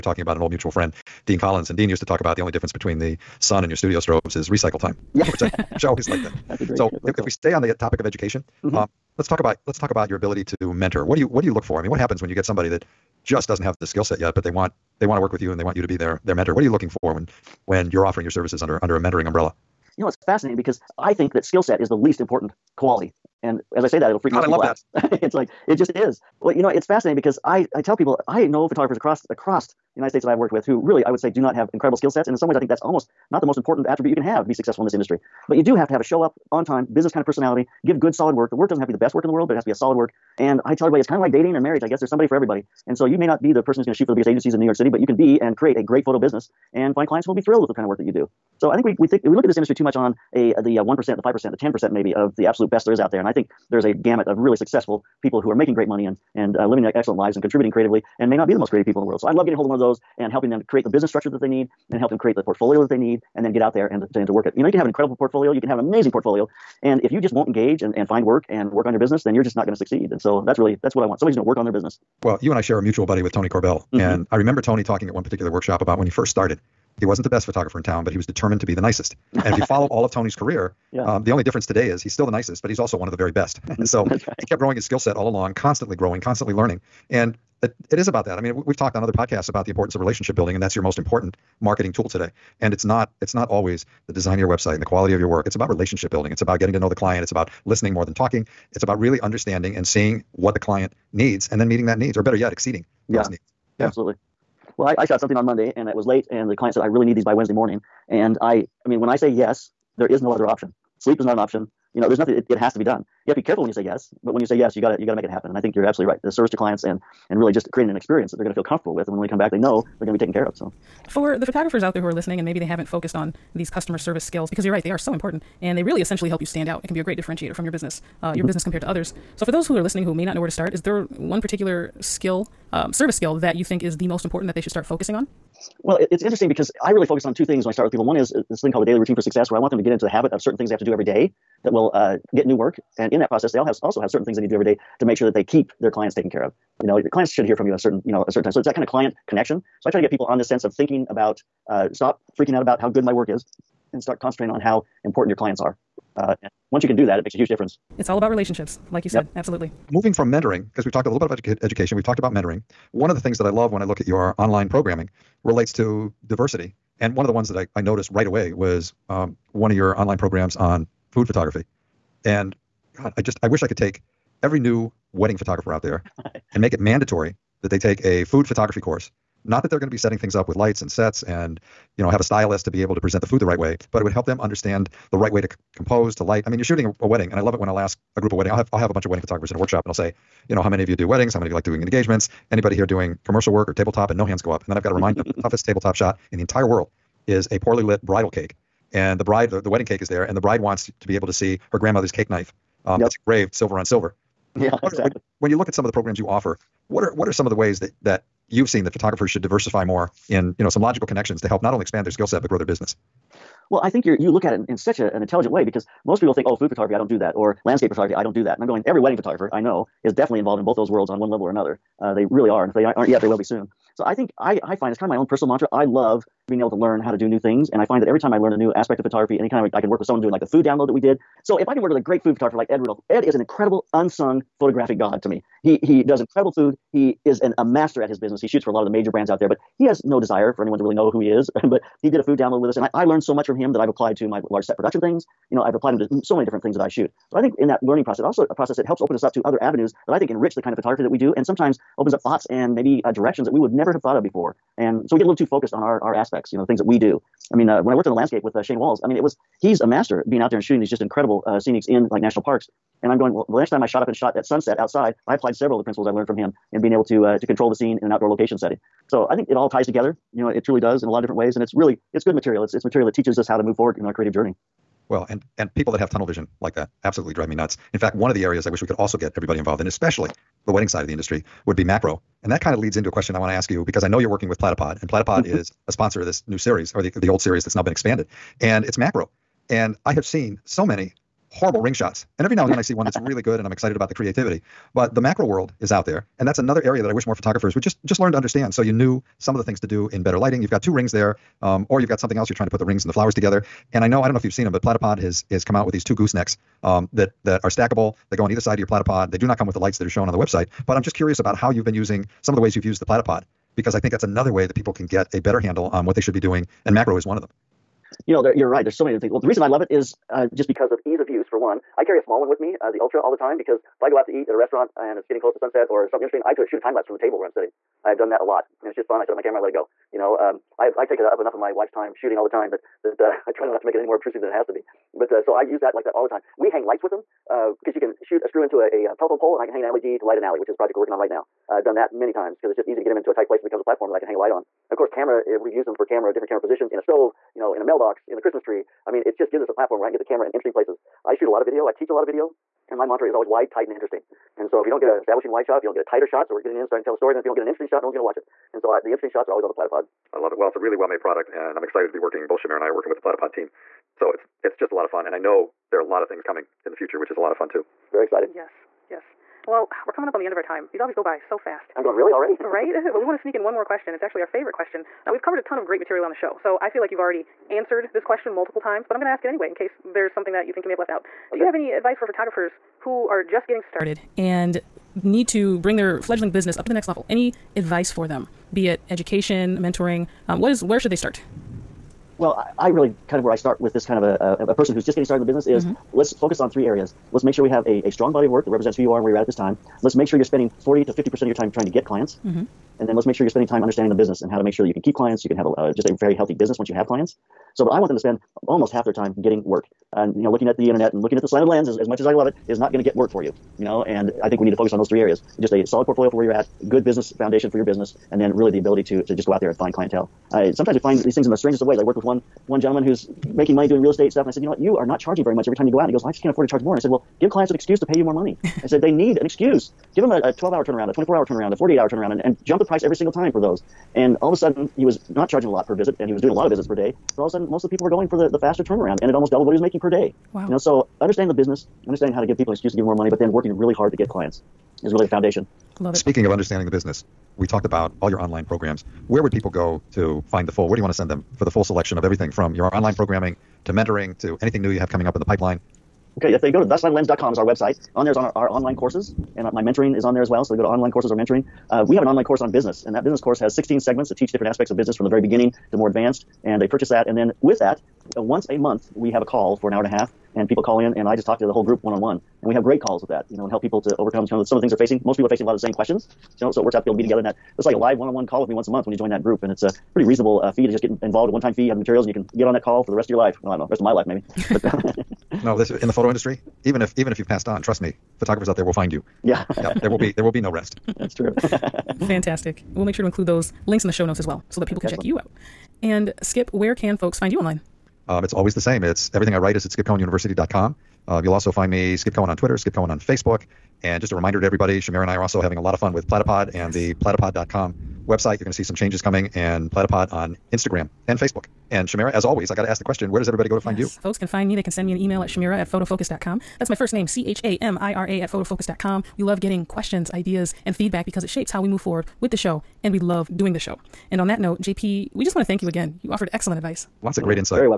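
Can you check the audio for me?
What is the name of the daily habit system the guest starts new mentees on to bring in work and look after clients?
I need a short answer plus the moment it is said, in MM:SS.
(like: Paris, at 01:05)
daily routine for success, at 02:18.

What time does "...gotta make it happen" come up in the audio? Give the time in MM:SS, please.
01:55.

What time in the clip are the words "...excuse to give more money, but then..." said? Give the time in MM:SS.
07:22.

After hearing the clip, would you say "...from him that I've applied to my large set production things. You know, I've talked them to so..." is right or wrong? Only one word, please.
wrong.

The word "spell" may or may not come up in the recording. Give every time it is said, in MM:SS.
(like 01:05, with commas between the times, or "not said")
not said.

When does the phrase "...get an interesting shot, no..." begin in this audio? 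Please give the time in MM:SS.
05:57.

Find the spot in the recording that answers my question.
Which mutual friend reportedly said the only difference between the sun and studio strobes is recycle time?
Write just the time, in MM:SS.
00:01.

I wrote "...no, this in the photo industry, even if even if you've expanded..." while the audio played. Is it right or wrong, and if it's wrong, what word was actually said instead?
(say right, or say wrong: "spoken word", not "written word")
wrong: "passed", not "expanded".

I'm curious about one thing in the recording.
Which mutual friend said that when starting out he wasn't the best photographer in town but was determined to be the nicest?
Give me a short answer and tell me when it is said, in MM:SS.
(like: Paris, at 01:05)
Tony Corbell, at 01:13.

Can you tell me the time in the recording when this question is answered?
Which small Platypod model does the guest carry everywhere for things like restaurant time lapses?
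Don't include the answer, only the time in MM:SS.
05:22.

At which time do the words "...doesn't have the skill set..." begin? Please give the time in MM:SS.
00:13.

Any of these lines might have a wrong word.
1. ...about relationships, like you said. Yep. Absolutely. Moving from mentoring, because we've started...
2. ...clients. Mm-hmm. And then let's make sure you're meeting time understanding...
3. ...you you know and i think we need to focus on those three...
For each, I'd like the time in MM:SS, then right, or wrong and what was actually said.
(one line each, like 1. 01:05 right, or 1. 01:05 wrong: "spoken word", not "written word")
1. 02:38 wrong: "talked", not "started"
2. 06:42 wrong: "spending", not "meeting"
3. 06:53 right.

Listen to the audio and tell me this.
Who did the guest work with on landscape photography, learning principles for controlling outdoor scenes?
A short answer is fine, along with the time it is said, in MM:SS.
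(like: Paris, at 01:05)
Shane Walls, at 04:18.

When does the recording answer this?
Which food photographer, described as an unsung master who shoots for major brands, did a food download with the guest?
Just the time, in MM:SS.
03:52.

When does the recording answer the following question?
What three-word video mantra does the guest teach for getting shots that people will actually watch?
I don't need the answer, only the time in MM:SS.
05:53.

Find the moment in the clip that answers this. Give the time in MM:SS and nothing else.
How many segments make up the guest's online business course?
07:43.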